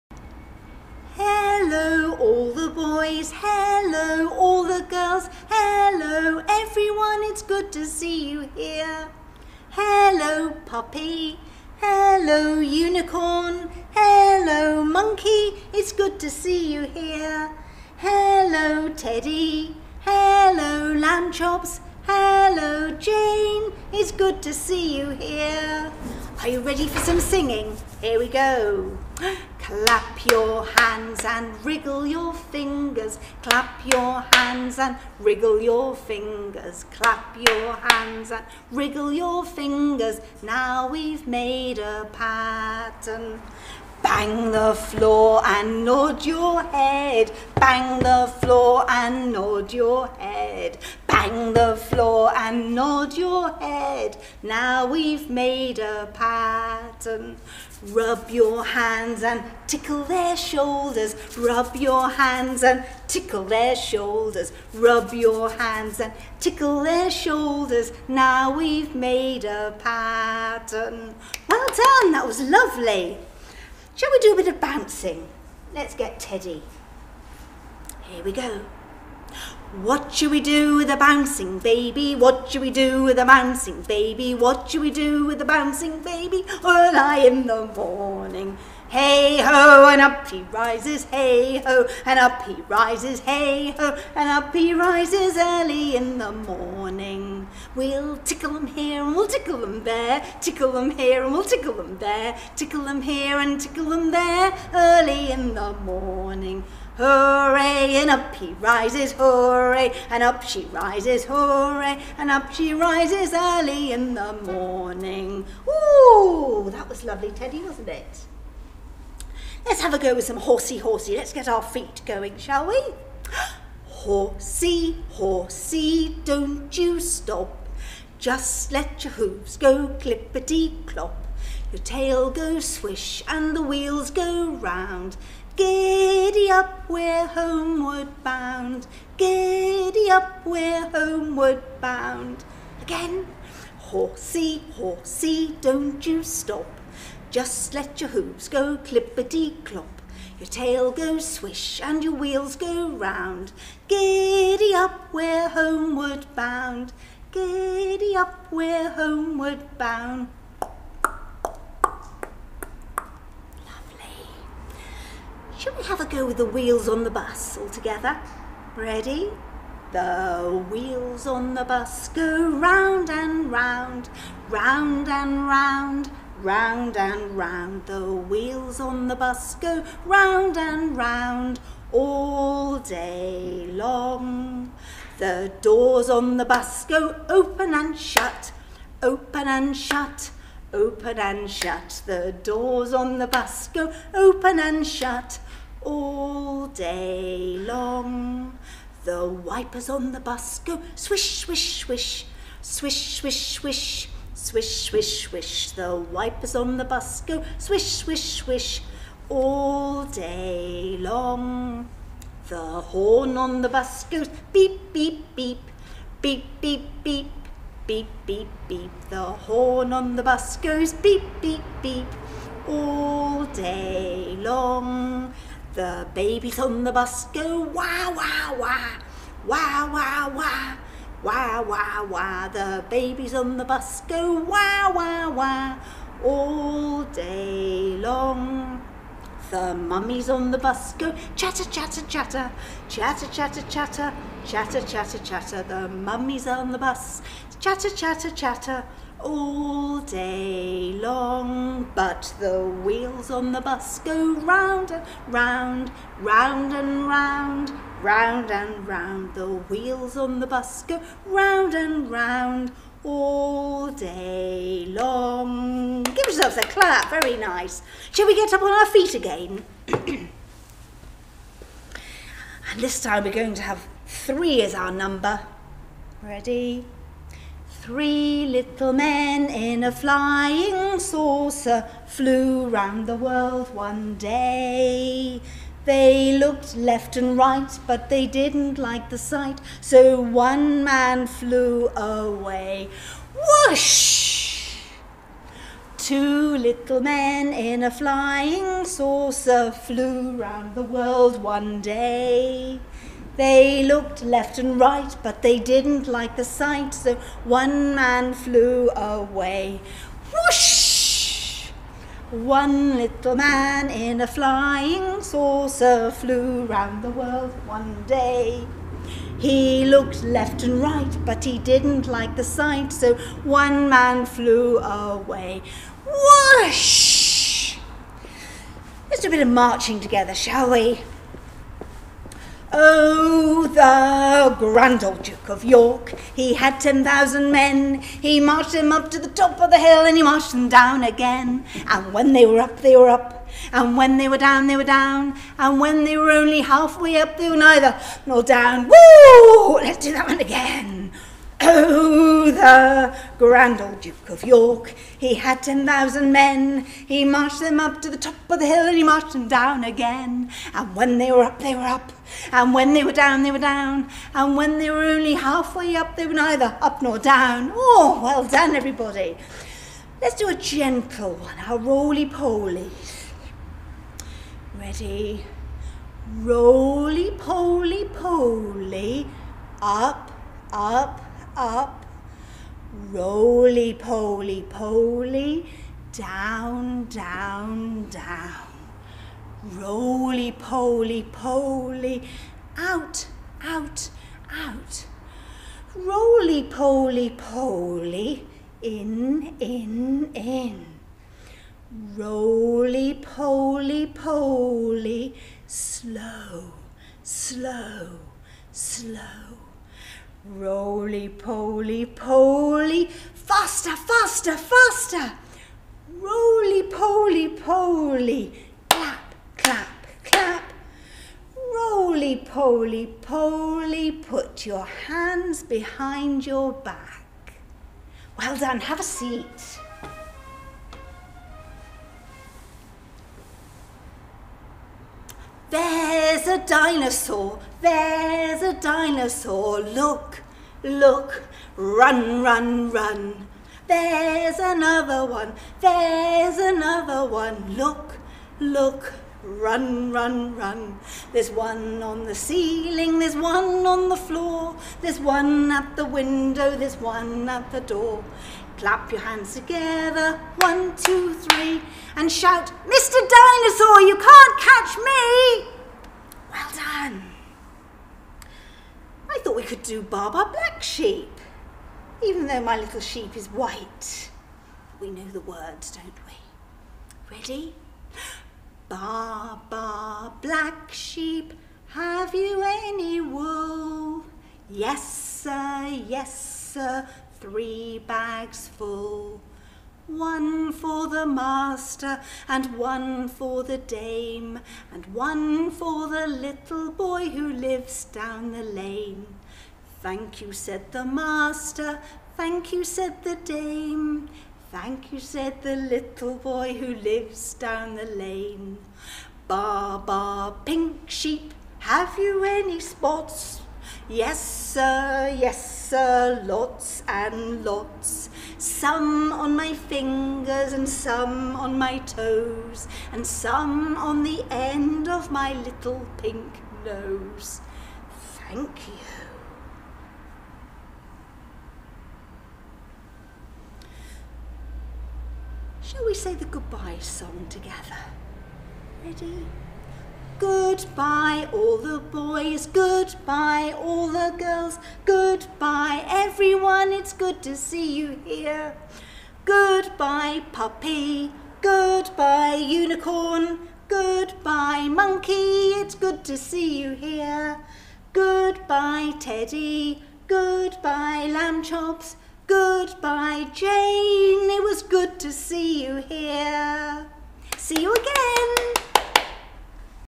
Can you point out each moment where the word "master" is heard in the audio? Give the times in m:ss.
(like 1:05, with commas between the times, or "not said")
8:11, 8:21.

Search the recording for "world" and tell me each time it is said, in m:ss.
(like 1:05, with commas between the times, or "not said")
4:43, 5:00, 5:17.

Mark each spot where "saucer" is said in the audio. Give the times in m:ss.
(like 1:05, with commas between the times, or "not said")
4:40, 4:58, 5:15.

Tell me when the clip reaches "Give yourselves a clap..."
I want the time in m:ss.
4:26.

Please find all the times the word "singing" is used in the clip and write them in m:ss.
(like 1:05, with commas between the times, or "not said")
0:27.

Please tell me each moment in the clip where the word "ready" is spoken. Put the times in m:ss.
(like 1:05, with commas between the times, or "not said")
0:26, 2:48, 4:36, 6:14, 7:57, 8:59.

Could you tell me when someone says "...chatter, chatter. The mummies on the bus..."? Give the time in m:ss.
4:04.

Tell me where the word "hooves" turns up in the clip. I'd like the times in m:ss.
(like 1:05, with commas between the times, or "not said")
2:09, 2:28.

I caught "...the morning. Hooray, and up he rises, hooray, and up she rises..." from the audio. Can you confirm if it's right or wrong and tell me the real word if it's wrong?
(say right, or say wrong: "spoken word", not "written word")
right.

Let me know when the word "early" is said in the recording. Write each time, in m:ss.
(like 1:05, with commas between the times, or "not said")
1:26, 1:35, 1:44, 1:53.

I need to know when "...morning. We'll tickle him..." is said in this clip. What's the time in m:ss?
1:36.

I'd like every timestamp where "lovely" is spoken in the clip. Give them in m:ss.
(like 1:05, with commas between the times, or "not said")
1:12, 1:57, 2:41.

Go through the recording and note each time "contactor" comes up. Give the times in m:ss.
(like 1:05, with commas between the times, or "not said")
not said.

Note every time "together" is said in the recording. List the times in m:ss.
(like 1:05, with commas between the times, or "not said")
2:47, 5:29, 7:39, 8:57.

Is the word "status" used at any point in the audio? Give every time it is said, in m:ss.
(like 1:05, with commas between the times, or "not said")
not said.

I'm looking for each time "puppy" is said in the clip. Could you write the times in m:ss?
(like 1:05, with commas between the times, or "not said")
0:10, 9:10.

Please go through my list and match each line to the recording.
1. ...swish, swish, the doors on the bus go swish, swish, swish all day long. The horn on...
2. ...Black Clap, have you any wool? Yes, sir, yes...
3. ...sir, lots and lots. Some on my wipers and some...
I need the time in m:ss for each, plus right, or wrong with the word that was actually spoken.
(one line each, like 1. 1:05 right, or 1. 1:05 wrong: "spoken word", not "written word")
1. 3:24 wrong: "wipers", not "doors"
2. 8:00 wrong: "Sheep", not "Clap"
3. 8:35 wrong: "fingers", not "wipers".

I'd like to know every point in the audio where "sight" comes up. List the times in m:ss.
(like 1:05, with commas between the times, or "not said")
4:49, 5:06, 5:22.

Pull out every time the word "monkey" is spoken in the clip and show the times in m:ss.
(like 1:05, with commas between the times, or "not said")
0:14, 9:14.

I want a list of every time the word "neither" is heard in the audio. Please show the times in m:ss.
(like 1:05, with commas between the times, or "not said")
5:47, 6:06.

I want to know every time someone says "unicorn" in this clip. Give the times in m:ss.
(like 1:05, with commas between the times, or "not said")
0:12, 9:12.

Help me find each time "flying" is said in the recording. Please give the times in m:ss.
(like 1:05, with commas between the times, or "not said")
4:39, 4:57, 5:14.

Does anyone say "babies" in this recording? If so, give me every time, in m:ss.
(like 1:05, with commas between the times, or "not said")
3:46, 3:52.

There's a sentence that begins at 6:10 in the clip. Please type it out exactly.
Let's do a gentle one, a roly-poly.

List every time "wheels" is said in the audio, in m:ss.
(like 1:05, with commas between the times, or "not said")
2:13, 2:32, 2:46, 2:50, 2:58, 4:12, 4:19.